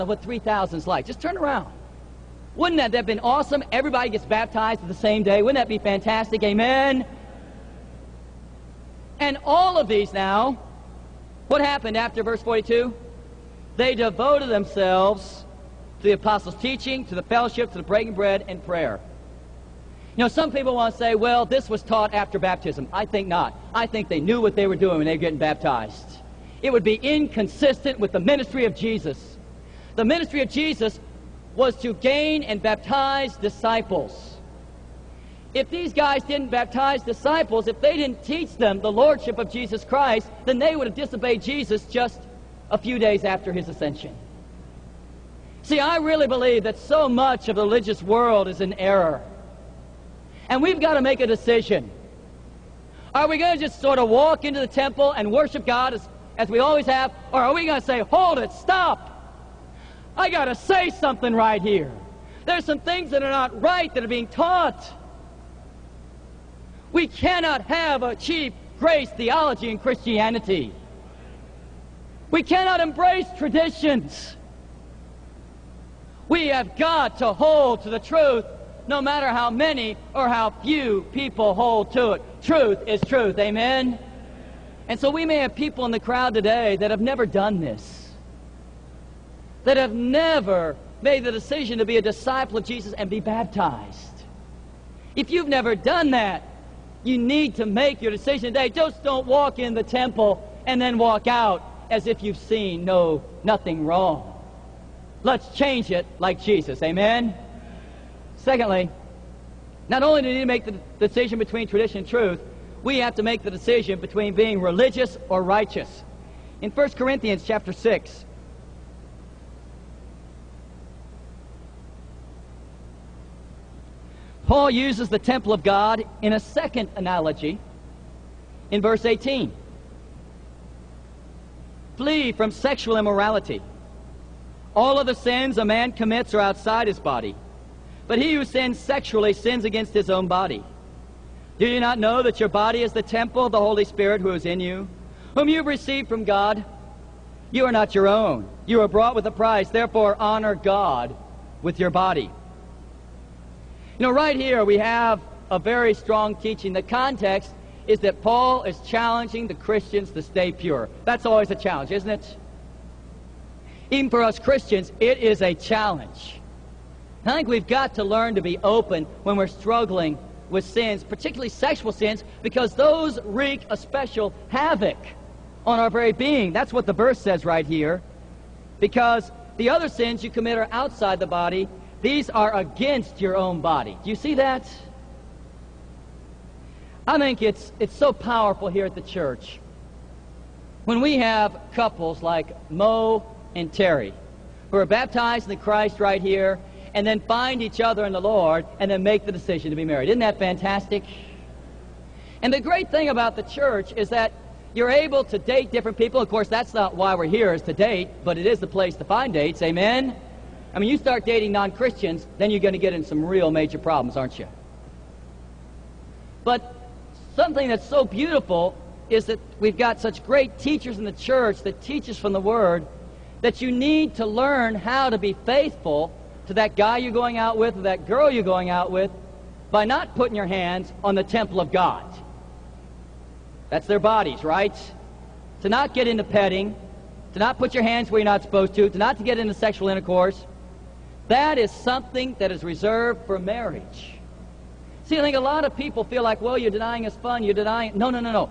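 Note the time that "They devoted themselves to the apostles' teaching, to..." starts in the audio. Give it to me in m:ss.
0:13.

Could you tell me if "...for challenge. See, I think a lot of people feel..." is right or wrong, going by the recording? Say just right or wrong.
wrong.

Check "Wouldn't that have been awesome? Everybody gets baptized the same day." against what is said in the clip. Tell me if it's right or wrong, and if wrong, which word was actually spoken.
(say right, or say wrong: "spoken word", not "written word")
right.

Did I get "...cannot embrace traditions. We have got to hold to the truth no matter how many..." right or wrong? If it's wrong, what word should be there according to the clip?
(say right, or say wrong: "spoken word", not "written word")
right.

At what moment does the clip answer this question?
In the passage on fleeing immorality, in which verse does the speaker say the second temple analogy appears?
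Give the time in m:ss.
2:08.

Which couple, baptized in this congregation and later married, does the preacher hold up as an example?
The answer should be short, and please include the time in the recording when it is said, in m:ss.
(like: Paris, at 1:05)
Mo and Terry, at 3:12.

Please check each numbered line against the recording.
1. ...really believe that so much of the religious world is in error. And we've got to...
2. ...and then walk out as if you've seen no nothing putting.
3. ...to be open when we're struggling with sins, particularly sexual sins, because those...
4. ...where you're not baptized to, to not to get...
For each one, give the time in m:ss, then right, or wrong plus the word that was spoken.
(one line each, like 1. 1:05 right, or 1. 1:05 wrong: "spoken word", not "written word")
1. 0:45 right
2. 1:40 wrong: "wrong", not "putting"
3. 2:48 right
4. 3:58 wrong: "supposed", not "baptized".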